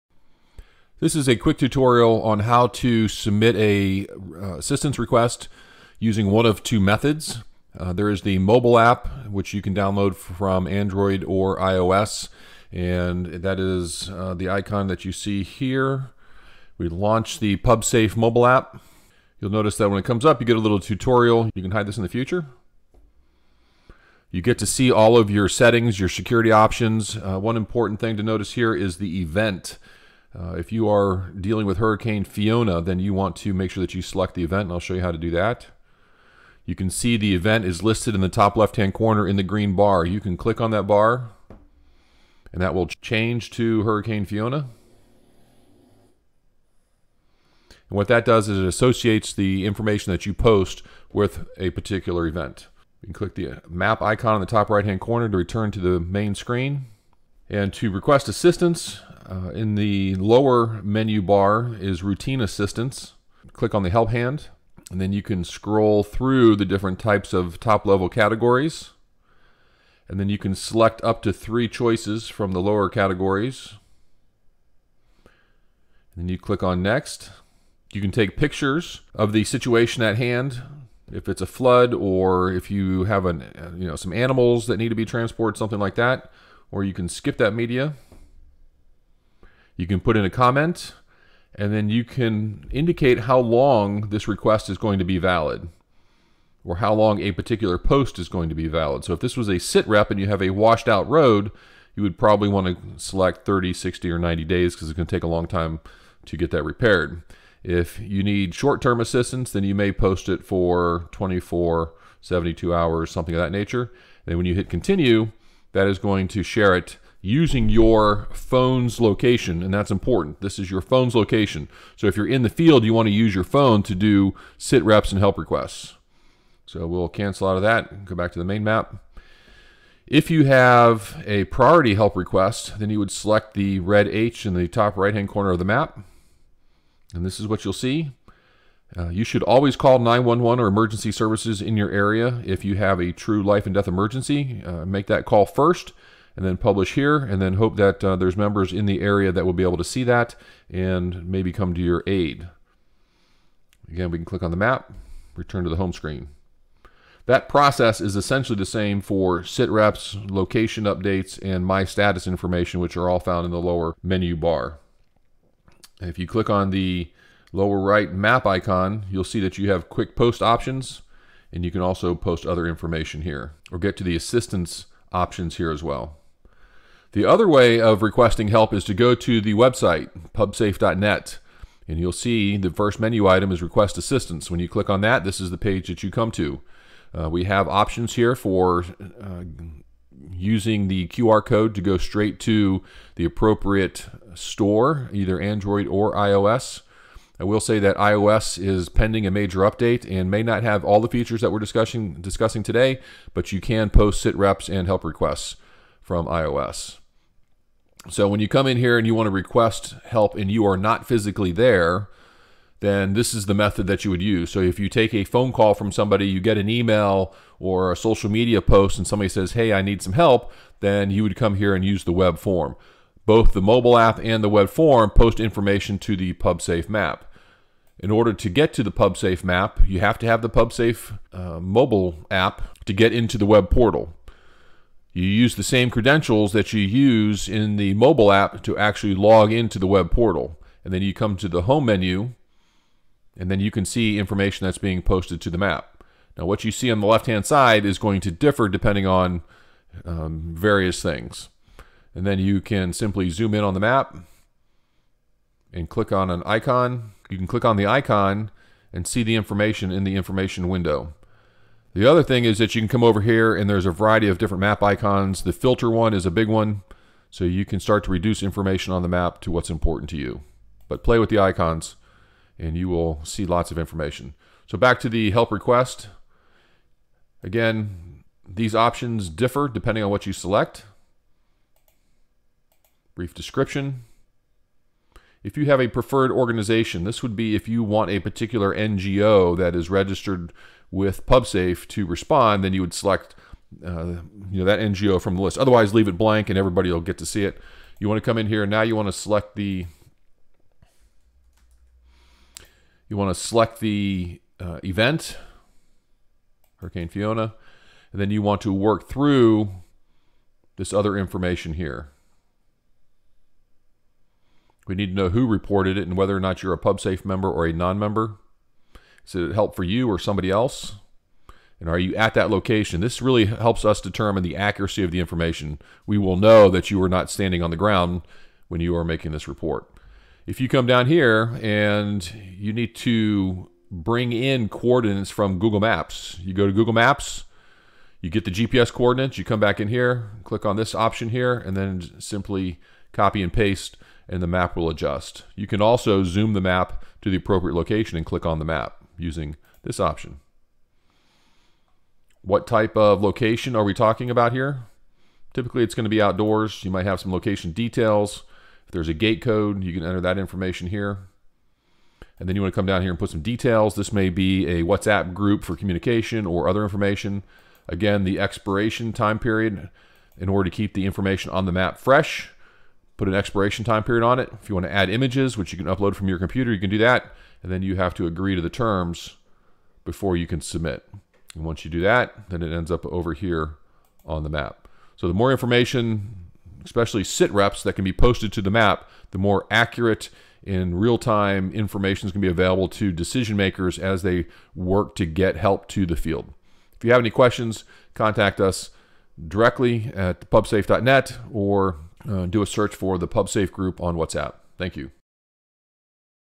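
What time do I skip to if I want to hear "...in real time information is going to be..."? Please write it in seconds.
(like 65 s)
390 s.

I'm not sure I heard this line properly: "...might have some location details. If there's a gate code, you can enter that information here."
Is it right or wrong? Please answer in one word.
right.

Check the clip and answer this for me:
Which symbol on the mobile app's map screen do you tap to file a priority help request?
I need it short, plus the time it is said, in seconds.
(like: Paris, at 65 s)
red H, at 133 s.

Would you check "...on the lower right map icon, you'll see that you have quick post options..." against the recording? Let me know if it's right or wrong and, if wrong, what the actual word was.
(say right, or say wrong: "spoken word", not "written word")
right.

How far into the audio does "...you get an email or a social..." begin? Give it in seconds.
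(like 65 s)
216 s.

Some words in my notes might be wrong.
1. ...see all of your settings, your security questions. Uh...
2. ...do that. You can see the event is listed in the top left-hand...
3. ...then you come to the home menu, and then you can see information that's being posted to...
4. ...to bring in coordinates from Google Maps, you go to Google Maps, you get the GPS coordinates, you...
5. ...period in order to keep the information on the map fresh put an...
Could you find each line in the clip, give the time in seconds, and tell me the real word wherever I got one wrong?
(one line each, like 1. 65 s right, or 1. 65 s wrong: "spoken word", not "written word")
1. 24 s wrong: "options", not "questions"
2. 35 s right
3. 240 s right
4. 332 s right
5. 369 s right.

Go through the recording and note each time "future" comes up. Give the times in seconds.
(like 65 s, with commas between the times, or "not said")
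22 s.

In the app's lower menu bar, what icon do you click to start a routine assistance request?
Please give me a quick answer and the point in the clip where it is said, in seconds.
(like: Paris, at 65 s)
help hand, at 63 s.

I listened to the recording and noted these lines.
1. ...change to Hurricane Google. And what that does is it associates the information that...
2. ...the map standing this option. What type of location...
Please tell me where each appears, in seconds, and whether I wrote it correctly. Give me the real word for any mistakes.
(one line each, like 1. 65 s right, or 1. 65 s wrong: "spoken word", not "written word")
1. 43 s wrong: "Fiona", not "Google"
2. 348 s wrong: "using", not "standing".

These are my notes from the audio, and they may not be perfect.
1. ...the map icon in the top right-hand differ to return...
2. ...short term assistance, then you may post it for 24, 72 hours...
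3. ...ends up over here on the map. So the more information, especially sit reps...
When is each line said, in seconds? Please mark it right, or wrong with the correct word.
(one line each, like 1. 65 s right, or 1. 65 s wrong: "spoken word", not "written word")
1. 53 s wrong: "corner", not "differ"
2. 108 s right
3. 382 s right.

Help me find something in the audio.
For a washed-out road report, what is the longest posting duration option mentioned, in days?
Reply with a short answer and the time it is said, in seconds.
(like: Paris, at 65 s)
90, at 104 s.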